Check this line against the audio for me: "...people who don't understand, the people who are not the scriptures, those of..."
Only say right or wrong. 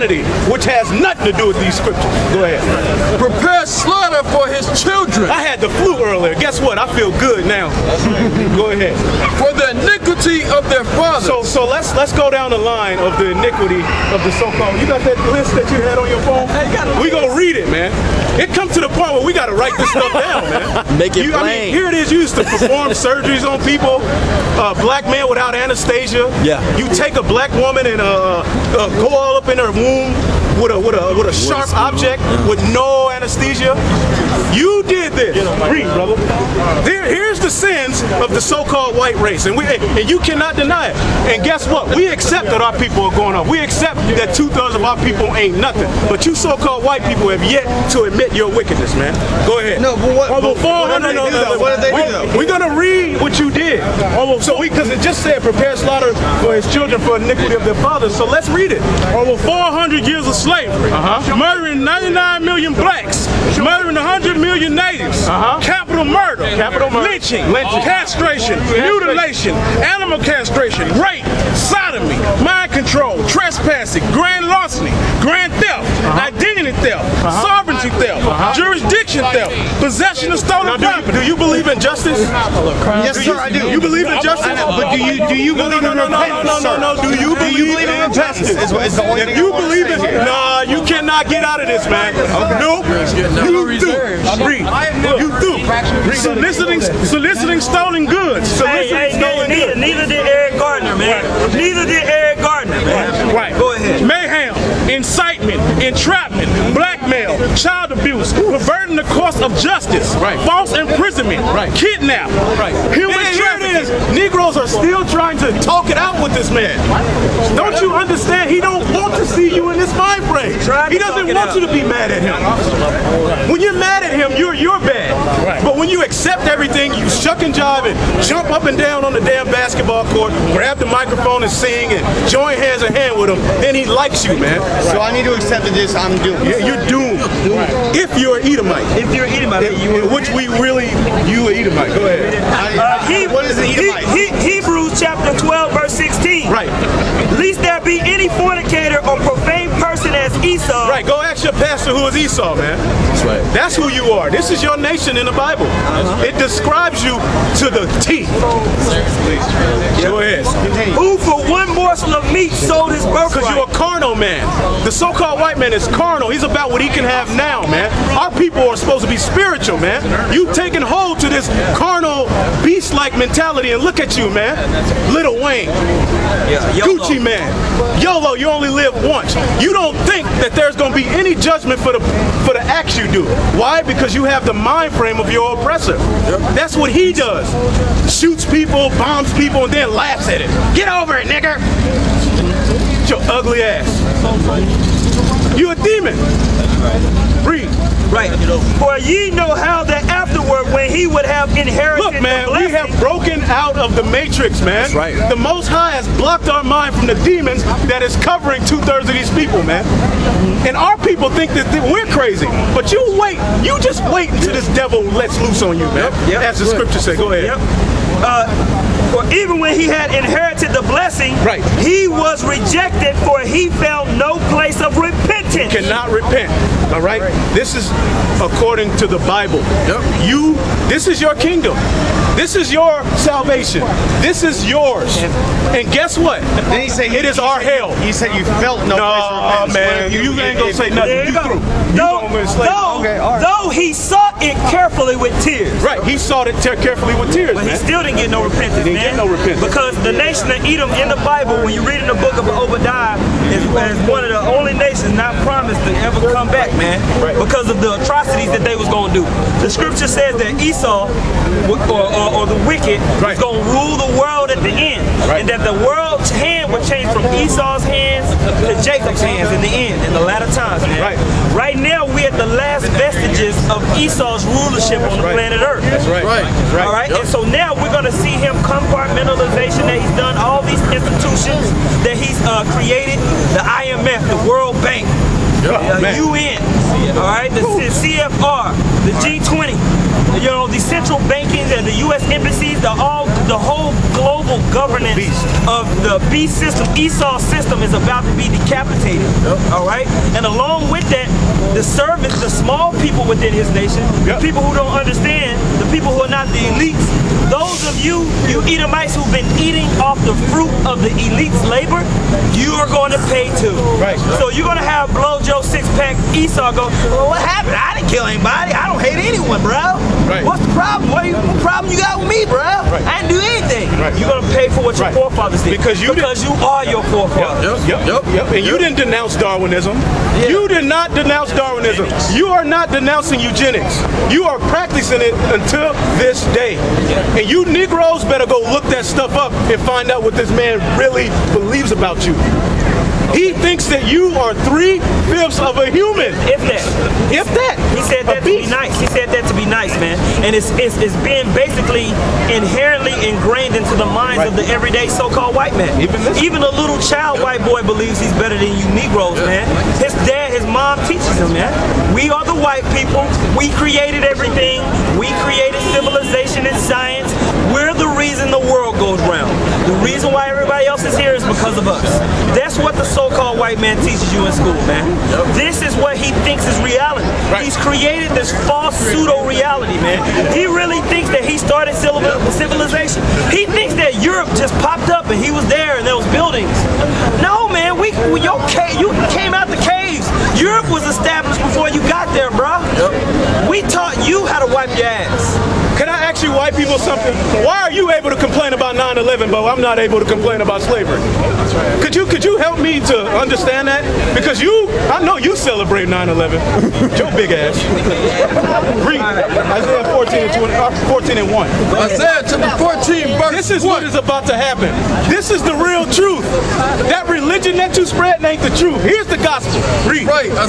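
wrong.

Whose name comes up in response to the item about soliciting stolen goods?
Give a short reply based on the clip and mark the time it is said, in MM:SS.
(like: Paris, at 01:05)
Eric Garner, at 01:40.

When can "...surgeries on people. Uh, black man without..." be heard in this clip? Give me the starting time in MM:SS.
00:22.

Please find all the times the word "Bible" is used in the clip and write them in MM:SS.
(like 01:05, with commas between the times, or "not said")
02:35, 03:49, 04:11.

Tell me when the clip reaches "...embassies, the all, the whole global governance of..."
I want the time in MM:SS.
04:52.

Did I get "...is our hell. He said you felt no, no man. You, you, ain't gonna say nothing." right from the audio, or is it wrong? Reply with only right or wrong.
right.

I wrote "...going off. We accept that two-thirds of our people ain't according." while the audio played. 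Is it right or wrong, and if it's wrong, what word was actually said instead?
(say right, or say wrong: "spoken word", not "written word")
wrong: "nothing", not "according".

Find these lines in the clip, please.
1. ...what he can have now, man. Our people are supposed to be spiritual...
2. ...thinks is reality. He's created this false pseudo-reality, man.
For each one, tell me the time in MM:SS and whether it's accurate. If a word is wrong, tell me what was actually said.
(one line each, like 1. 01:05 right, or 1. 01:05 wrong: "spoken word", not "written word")
1. 02:46 right
2. 06:16 right.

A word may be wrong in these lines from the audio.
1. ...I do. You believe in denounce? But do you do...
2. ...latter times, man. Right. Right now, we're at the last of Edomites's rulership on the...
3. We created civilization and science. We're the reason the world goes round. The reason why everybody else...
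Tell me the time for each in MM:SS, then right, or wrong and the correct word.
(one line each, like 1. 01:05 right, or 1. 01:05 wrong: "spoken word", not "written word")
1. 01:23 wrong: "justice", not "denounce"
2. 04:30 wrong: "Esau", not "Edomites"
3. 06:05 right.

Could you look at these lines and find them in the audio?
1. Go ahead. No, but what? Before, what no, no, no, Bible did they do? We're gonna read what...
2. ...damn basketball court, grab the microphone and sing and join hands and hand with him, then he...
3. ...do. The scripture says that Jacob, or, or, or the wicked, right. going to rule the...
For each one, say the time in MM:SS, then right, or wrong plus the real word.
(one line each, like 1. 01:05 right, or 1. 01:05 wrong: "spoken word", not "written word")
1. 00:49 wrong: "What", not "Bible"
2. 02:09 right
3. 04:19 wrong: "Esau", not "Jacob".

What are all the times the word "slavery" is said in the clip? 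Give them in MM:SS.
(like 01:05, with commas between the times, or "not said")
01:00, 06:40.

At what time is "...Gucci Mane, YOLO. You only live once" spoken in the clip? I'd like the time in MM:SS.
02:56.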